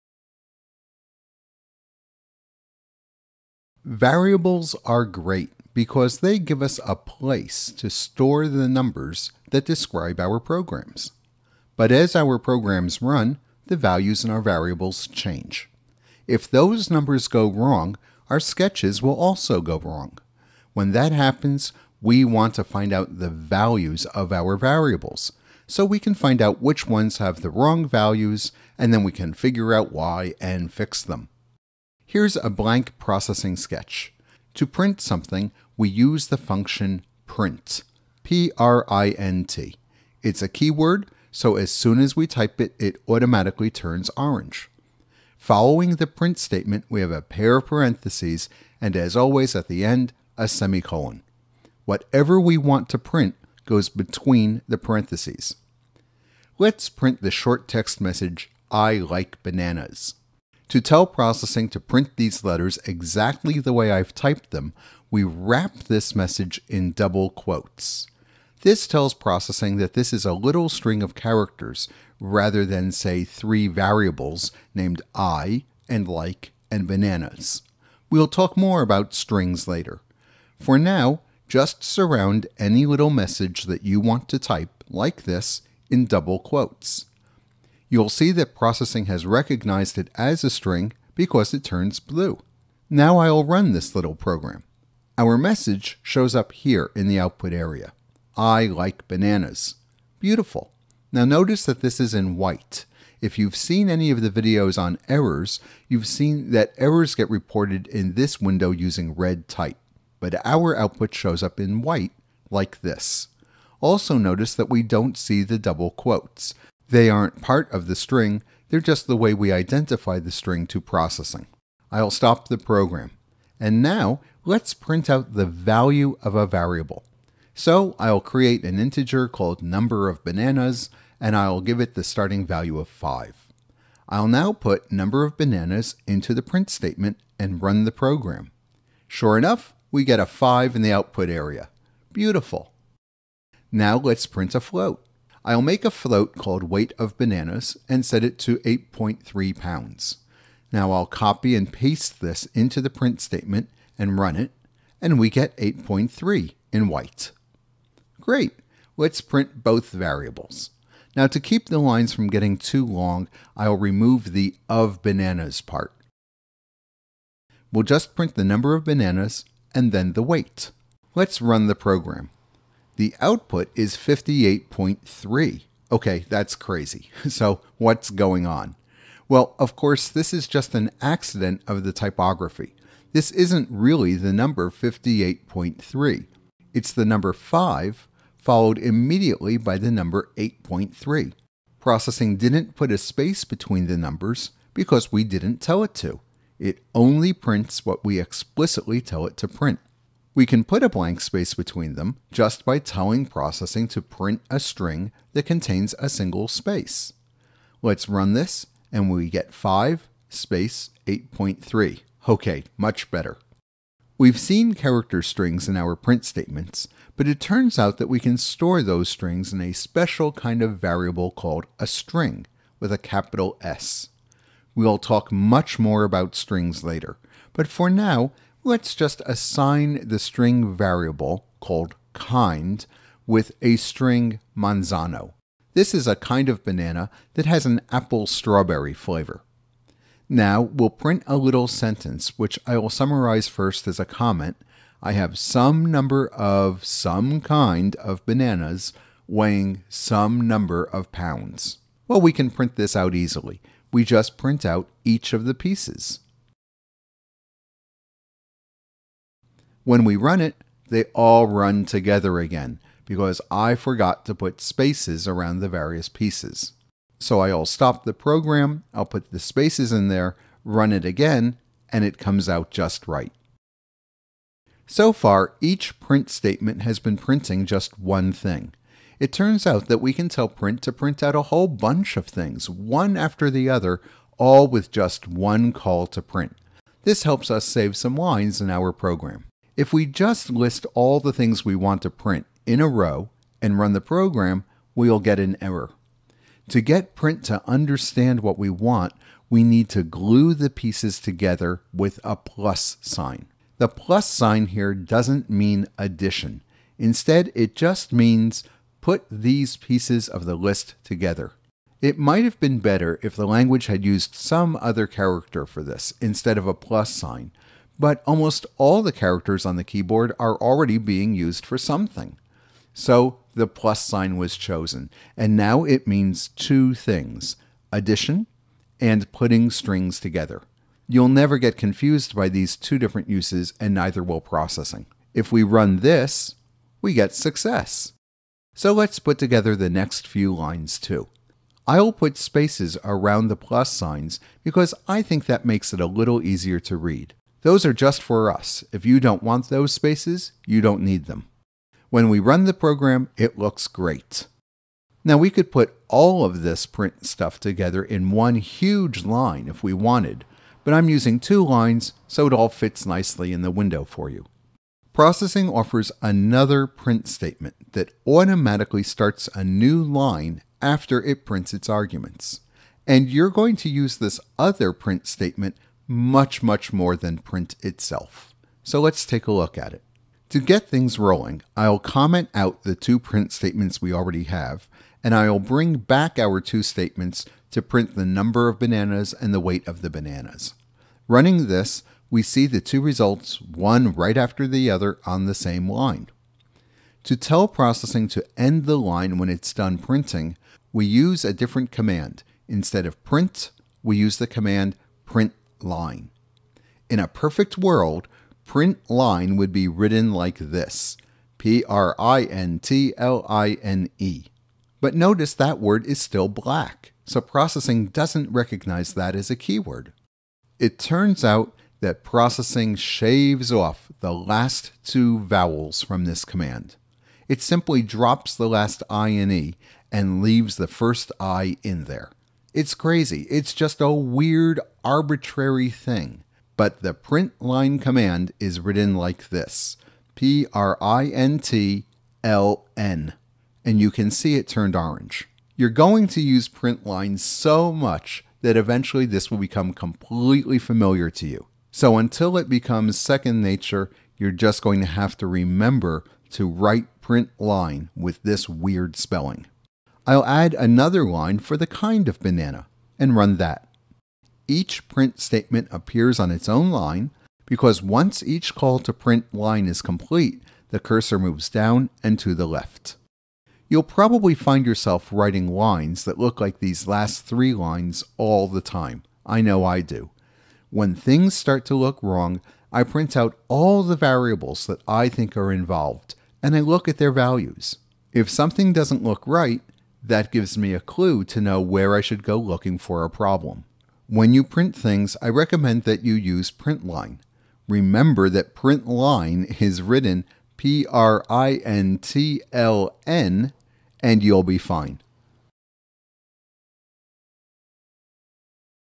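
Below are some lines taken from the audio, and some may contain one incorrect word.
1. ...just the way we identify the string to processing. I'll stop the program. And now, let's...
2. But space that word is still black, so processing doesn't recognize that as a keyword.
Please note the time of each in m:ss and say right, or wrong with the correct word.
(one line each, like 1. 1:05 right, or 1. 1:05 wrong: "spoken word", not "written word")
1. 1:58 right
2. 6:54 wrong: "notice", not "space".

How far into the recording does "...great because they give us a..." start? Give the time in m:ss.
0:05.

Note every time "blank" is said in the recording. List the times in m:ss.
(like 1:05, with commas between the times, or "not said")
0:32, 3:20.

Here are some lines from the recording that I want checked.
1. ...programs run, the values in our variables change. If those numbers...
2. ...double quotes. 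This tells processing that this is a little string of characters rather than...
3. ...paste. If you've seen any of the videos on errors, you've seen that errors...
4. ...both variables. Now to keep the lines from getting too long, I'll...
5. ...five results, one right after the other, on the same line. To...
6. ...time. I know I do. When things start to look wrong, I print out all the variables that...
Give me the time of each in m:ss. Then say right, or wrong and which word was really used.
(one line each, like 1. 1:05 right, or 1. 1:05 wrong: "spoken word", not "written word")
1. 0:12 right
2. 1:06 right
3. 1:42 wrong: "white", not "paste"
4. 2:39 right
5. 6:32 wrong: "two", not "five"
6. 7:58 right.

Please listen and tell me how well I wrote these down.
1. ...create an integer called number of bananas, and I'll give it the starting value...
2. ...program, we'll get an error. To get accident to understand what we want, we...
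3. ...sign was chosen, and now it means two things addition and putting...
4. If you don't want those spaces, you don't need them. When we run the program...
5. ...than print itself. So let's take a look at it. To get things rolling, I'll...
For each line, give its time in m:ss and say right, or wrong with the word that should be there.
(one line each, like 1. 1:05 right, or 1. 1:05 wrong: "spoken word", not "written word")
1. 2:08 right
2. 4:54 wrong: "print", not "accident"
3. 5:24 right
4. 5:48 right
5. 6:17 right.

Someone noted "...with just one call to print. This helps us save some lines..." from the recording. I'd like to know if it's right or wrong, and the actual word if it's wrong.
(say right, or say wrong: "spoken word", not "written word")
right.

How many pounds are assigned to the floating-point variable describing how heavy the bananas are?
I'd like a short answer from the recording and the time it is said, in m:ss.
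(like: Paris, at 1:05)
8.3, at 2:28.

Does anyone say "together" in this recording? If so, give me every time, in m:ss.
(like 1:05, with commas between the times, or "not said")
4:21, 5:01, 5:11, 5:30, 5:39, 5:57.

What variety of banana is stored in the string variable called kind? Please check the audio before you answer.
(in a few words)
Manzano.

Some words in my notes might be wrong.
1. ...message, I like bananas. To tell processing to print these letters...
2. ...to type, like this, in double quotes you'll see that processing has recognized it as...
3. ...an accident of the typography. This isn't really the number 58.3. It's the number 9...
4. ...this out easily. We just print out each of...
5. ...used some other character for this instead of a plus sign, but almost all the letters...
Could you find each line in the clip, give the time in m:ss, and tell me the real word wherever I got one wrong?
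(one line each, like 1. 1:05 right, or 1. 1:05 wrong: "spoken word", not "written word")
1. 0:58 right
2. 1:24 right
3. 3:00 wrong: "5", not "9"
4. 4:12 right
5. 5:14 wrong: "characters", not "letters".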